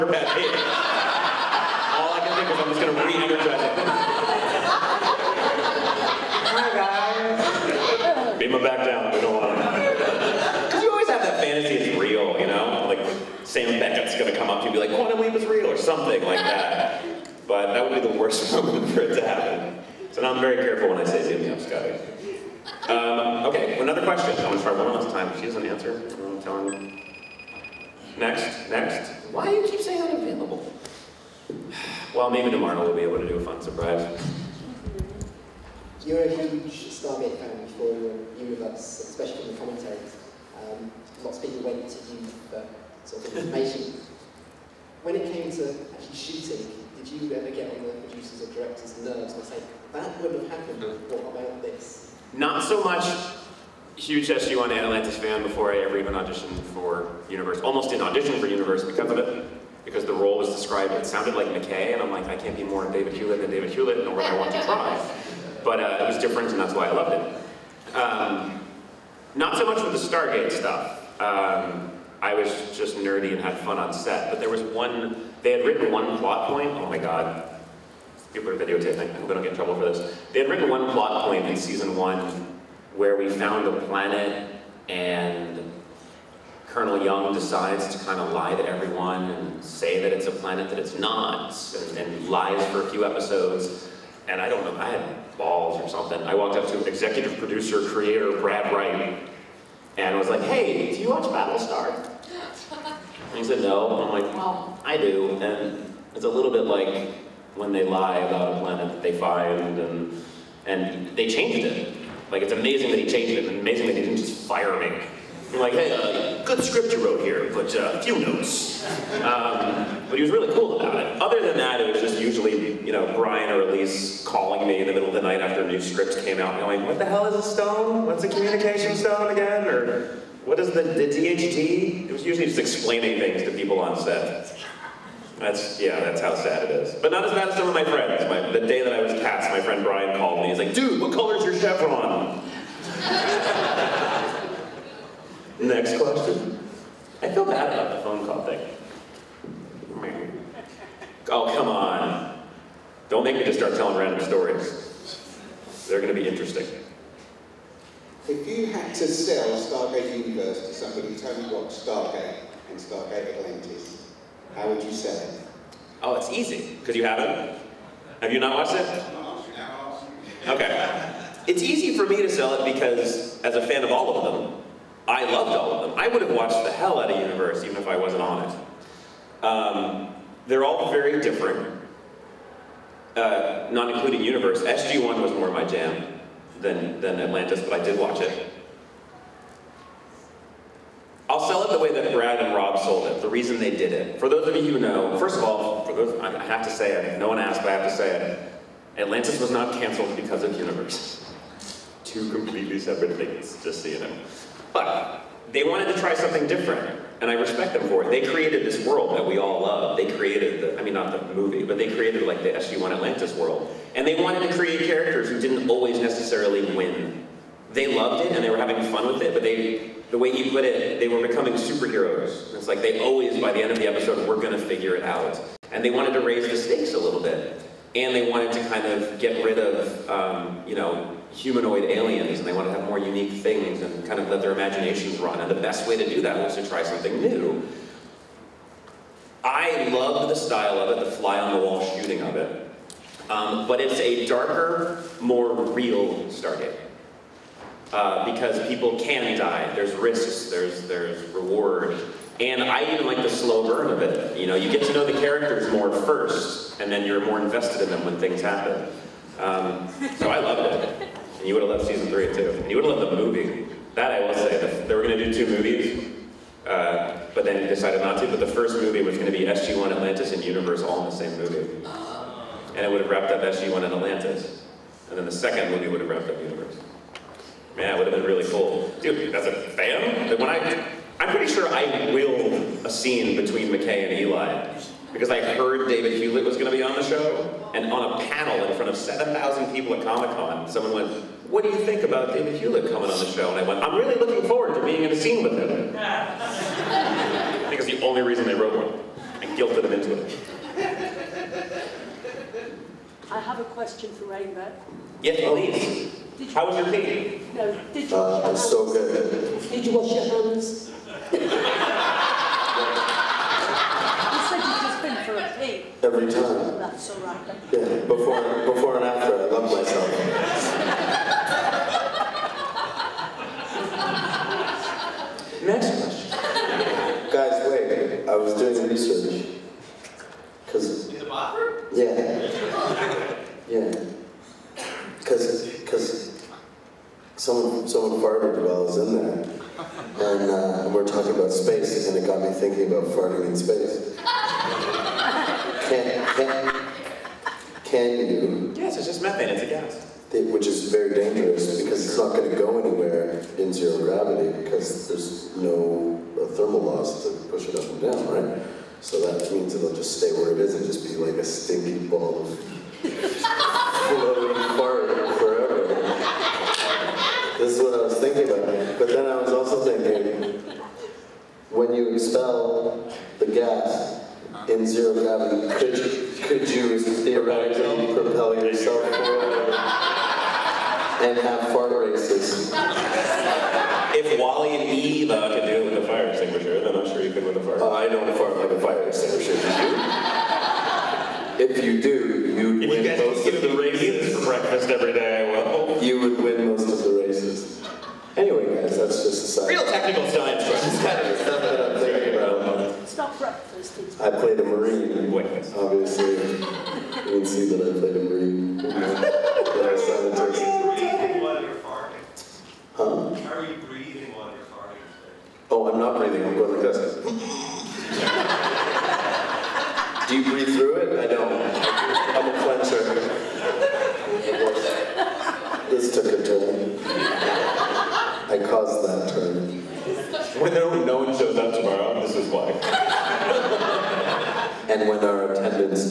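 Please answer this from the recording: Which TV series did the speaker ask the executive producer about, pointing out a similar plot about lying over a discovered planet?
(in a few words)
Battlestar.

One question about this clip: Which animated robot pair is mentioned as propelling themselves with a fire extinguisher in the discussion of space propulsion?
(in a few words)
WALL-E and Eva.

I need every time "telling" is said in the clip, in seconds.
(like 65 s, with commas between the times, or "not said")
26 s, 153 s.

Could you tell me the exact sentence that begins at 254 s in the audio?
You know, you get to know the characters more first, and then you're more invested in them when things happen.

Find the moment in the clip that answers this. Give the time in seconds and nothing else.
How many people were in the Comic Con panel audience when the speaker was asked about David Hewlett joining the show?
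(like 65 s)
288 s.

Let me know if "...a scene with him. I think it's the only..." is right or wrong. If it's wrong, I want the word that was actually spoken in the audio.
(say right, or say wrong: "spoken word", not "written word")
right.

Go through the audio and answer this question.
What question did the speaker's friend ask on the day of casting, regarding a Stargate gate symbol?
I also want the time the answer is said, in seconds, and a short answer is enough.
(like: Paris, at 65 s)
What color is your chevron, at 141 s.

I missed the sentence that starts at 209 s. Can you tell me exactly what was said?
They created the, I mean, not the movie, but they created like the SG-1 Atlantis world.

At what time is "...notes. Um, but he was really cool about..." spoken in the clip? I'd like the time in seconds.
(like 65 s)
118 s.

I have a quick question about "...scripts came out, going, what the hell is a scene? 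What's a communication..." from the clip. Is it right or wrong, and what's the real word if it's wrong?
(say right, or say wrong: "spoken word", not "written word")
wrong: "stone", not "scene".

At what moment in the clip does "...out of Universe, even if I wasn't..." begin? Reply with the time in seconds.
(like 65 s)
176 s.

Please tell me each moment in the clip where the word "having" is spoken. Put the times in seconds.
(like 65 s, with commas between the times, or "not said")
218 s.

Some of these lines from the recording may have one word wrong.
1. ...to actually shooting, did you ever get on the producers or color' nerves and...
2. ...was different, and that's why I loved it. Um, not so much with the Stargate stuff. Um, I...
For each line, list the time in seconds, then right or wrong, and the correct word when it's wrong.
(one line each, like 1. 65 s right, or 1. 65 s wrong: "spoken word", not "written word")
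1. 45 s wrong: "directors", not "color"
2. 66 s right.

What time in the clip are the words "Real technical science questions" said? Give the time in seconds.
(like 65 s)
399 s.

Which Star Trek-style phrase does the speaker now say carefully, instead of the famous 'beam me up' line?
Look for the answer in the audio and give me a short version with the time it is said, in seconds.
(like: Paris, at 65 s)
Zoom me up, Scotty, at 21 s.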